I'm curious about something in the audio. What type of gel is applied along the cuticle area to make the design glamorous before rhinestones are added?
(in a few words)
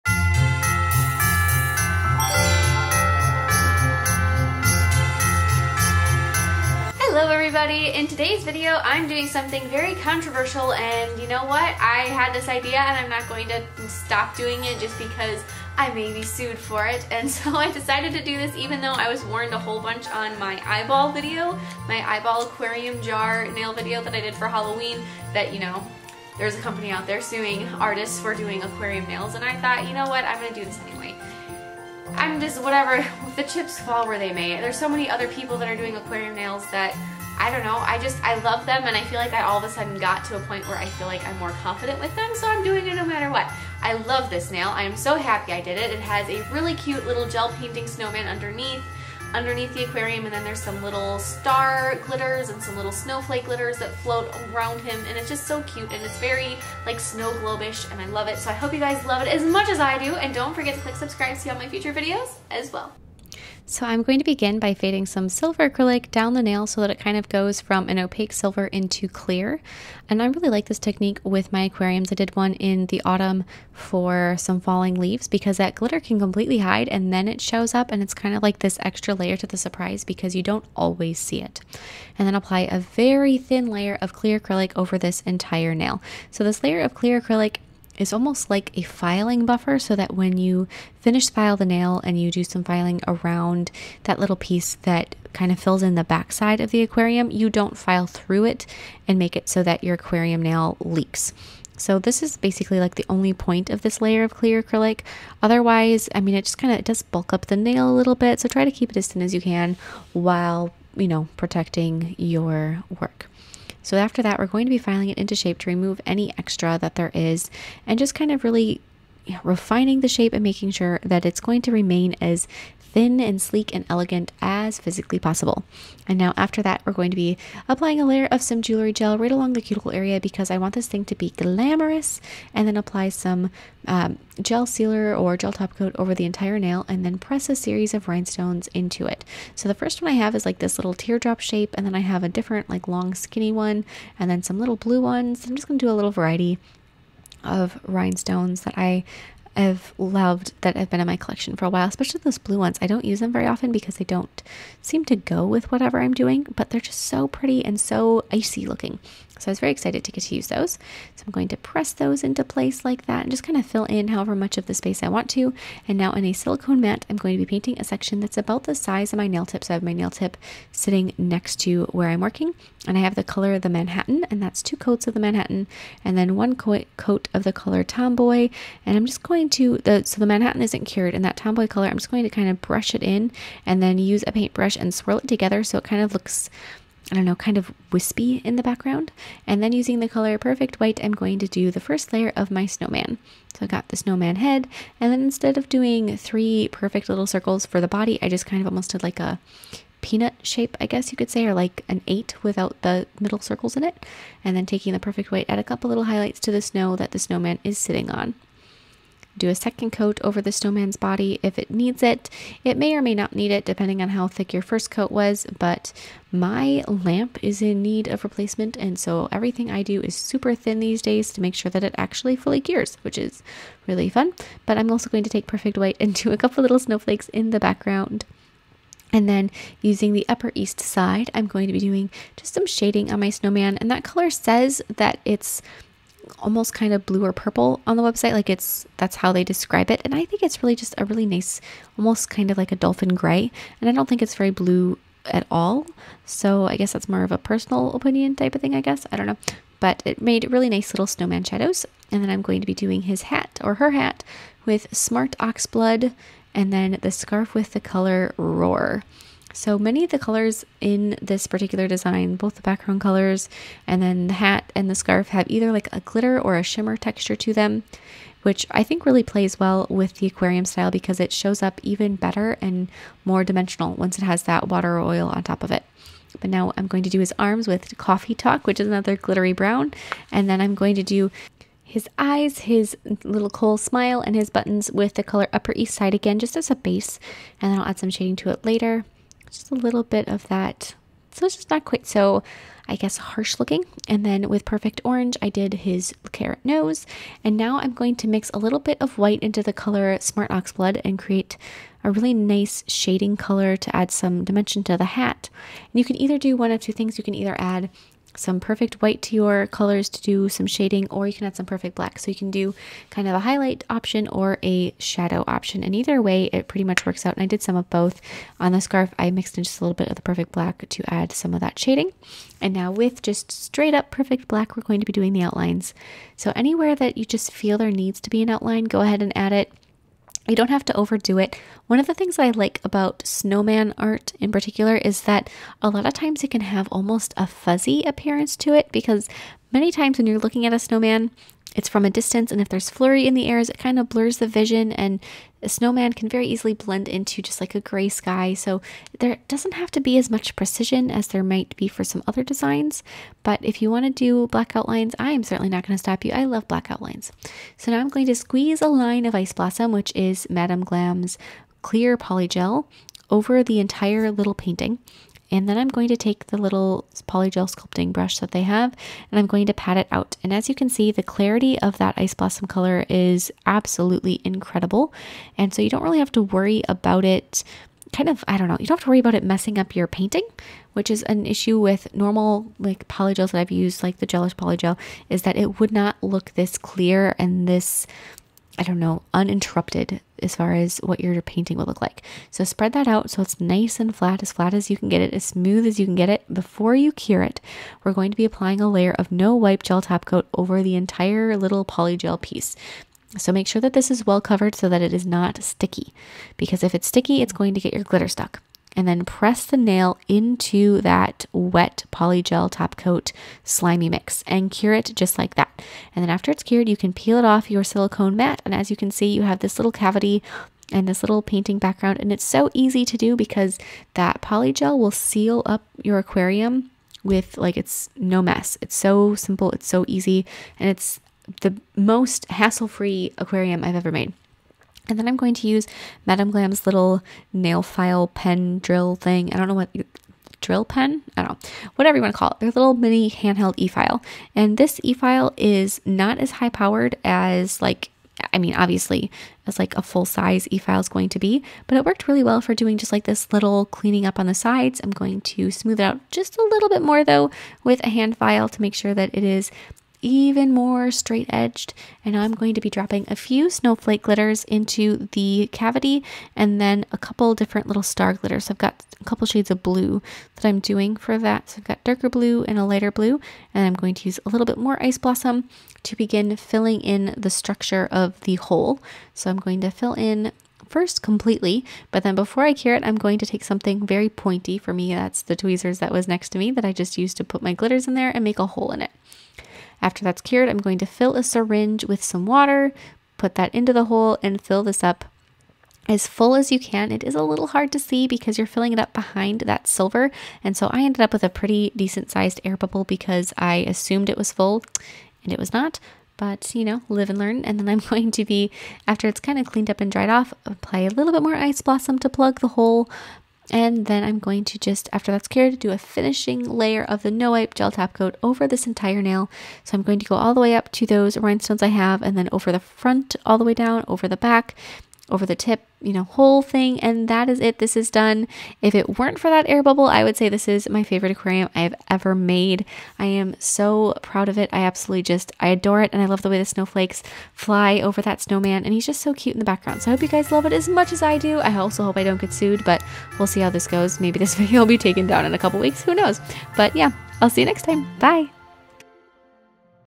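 jewelry gel.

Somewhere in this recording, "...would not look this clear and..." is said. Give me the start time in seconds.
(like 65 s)
385 s.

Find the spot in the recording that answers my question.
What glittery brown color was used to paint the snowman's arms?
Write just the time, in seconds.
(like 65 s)
277 s.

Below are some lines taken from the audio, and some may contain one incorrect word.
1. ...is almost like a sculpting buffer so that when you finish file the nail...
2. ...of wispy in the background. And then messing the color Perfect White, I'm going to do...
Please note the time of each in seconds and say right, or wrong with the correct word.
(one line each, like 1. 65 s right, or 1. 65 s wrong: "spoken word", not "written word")
1. 87 s wrong: "filing", not "sculpting"
2. 187 s wrong: "using", not "messing".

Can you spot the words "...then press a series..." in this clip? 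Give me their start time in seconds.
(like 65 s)
137 s.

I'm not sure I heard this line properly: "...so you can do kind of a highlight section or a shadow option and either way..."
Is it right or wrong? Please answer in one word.
wrong.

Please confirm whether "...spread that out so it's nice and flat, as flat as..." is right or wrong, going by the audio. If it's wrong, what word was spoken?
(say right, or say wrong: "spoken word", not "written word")
right.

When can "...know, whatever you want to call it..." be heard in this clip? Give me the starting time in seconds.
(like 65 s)
441 s.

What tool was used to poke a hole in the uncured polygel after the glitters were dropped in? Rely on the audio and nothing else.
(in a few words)
tweezers.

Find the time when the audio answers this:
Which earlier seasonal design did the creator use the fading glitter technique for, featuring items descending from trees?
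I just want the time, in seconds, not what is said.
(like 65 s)
74 s.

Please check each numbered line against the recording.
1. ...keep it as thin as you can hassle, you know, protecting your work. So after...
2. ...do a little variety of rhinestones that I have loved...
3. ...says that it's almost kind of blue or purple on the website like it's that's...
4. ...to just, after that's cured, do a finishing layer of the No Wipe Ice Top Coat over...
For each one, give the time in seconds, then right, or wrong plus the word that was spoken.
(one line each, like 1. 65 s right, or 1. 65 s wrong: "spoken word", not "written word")
1. 108 s wrong: "while", not "hassle"
2. 145 s right
3. 234 s right
4. 514 s wrong: "Gel", not "Ice".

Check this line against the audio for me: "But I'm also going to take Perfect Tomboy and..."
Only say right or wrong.
wrong.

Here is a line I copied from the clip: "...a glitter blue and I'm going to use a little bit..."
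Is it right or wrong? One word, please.
wrong.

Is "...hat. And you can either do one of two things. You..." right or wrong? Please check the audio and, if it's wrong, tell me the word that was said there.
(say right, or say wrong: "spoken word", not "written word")
right.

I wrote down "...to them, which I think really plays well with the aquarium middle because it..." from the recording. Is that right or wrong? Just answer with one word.
wrong.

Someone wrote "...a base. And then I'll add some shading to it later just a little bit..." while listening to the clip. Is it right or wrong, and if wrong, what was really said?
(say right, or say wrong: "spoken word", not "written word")
right.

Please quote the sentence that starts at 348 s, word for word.
So there doesn't have to be as much precision as there might be for some other designs.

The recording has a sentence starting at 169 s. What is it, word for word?
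So I have my nail tip sitting next to where I'm working.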